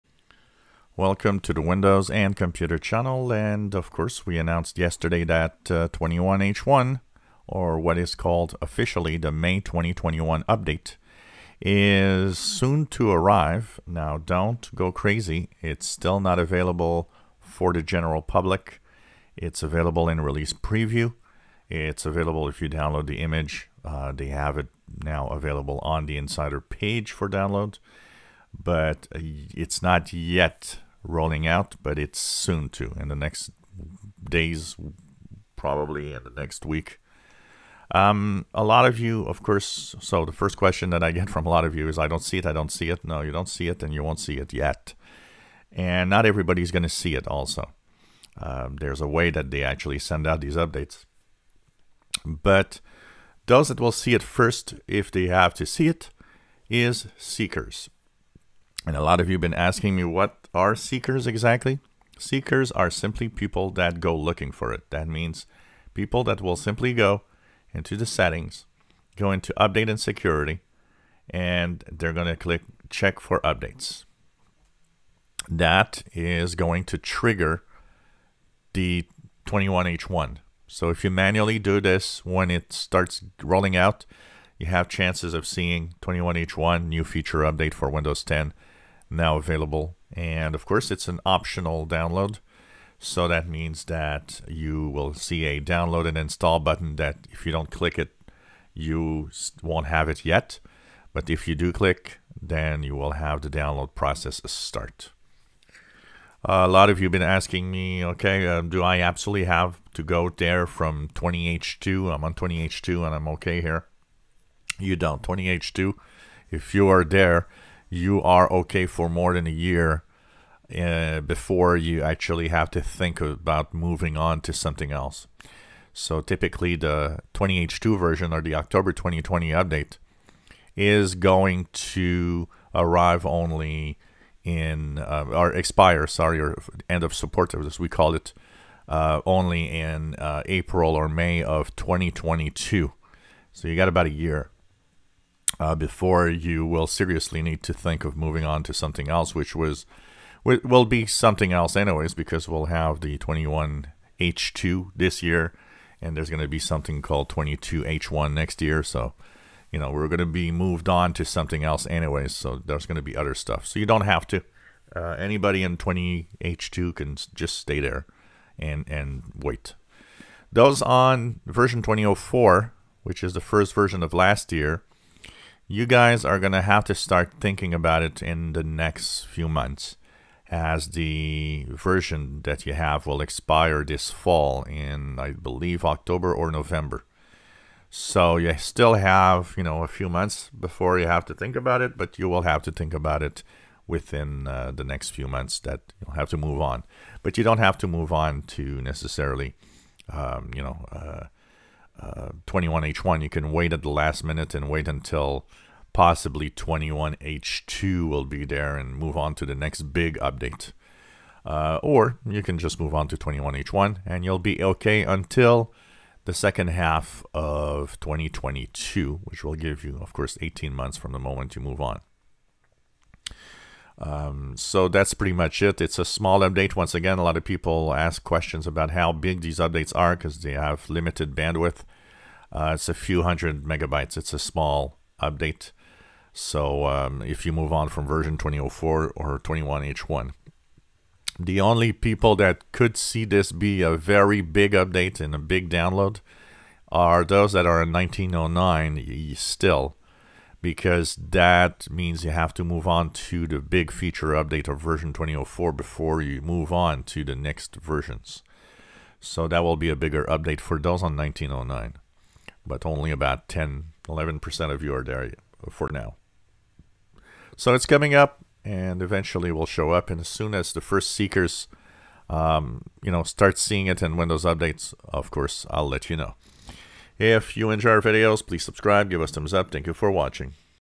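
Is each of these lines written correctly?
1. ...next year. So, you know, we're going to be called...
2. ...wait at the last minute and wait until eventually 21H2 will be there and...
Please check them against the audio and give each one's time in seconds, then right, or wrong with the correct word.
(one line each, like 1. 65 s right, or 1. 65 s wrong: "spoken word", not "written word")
1. 158 s wrong: "moved", not "called"
2. 203 s wrong: "possibly", not "eventually".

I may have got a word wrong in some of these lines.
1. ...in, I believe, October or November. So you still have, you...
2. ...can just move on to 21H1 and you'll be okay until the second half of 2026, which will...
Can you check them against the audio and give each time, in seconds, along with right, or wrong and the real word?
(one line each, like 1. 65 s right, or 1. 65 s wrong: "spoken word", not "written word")
1. 184 s right
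2. 212 s wrong: "2022", not "2026".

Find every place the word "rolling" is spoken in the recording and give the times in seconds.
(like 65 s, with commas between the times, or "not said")
31 s, 83 s.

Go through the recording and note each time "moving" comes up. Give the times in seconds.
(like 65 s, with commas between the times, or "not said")
123 s, 148 s.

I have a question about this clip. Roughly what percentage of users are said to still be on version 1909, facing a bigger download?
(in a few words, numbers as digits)
10-11%.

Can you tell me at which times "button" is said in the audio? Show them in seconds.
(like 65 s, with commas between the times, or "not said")
96 s.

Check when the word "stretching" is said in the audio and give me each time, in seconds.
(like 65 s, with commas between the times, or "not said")
not said.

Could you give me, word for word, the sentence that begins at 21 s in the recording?
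It's available if you download the image.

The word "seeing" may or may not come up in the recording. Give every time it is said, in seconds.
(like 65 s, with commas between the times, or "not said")
85 s, 273 s.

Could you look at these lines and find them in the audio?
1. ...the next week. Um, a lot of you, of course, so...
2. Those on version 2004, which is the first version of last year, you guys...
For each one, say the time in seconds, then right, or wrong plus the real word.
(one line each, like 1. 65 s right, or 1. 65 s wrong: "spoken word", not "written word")
1. 36 s right
2. 170 s right.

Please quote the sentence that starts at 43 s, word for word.
No, you don't see it, and you won't see it yet.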